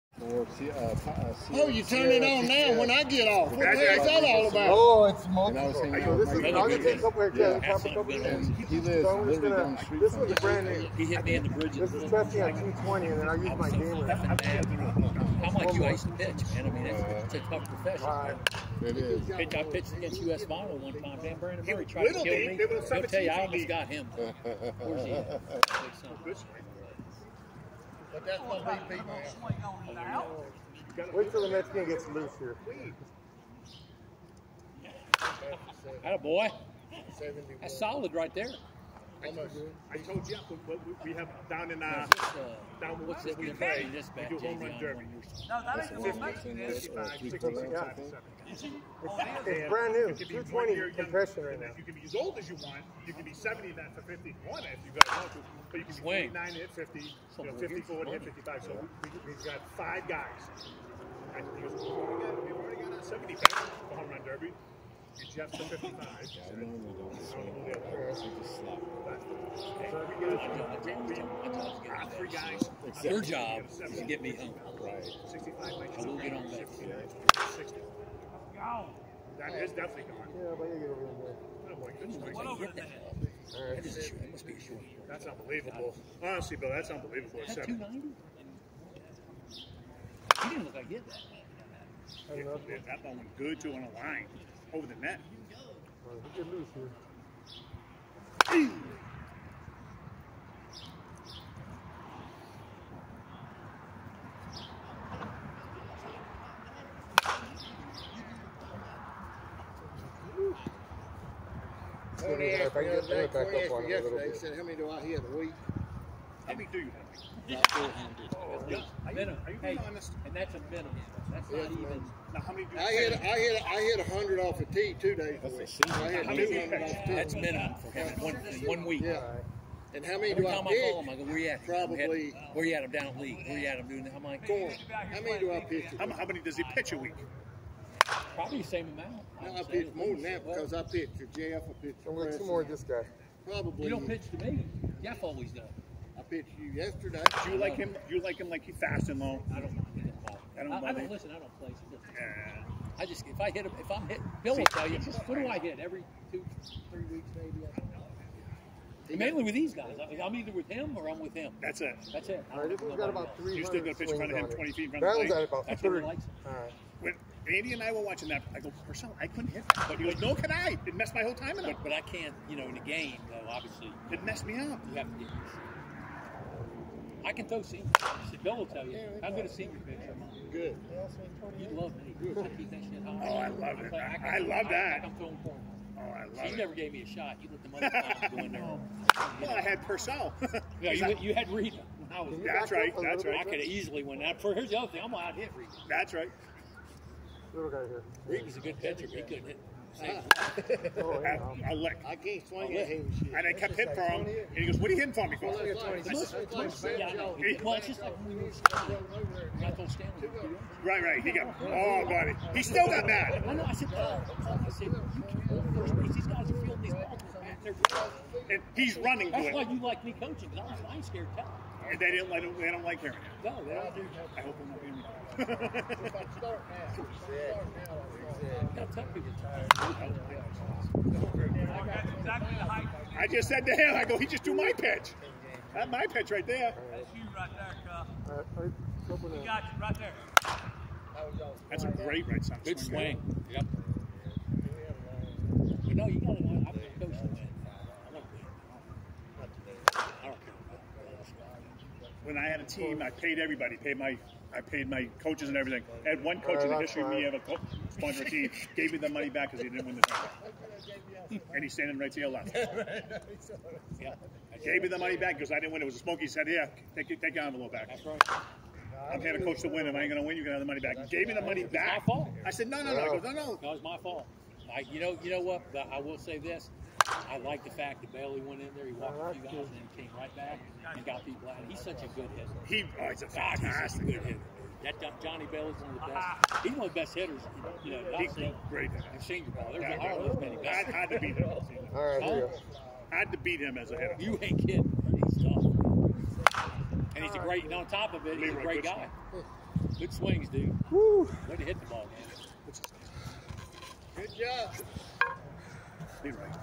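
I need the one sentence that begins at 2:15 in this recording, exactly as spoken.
How, how many does he pitch a week?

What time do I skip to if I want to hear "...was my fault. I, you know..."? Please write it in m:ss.
4:33.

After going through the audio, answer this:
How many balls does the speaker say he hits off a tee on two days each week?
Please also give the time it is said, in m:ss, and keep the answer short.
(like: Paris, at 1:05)
100, at 2:04.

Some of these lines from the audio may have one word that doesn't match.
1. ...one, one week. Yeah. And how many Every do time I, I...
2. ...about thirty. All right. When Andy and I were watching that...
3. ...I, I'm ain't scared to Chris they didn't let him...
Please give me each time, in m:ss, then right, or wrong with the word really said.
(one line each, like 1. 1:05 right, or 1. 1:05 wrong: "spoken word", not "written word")
1. 2:08 right
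2. 2:45 right
3. 3:40 wrong: "And", not "Chris".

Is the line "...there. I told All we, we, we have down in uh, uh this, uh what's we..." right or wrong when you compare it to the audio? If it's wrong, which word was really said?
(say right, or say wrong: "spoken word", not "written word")
wrong: "Jeff", not "All".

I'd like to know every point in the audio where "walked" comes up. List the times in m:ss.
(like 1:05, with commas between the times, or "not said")
4:38.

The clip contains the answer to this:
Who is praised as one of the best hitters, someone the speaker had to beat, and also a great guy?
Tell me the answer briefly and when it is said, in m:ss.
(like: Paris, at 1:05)
Johnny Bailey, at 4:45.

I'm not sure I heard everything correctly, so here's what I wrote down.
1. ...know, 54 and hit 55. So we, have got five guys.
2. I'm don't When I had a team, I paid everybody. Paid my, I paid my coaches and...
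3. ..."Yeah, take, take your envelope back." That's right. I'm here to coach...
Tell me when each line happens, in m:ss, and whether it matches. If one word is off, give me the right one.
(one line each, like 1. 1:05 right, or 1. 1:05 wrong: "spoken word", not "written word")
1. 0:57 right
2. 4:06 right
3. 4:26 right.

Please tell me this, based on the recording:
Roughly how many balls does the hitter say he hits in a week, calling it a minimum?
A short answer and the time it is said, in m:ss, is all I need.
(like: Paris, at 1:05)
400, at 1:57.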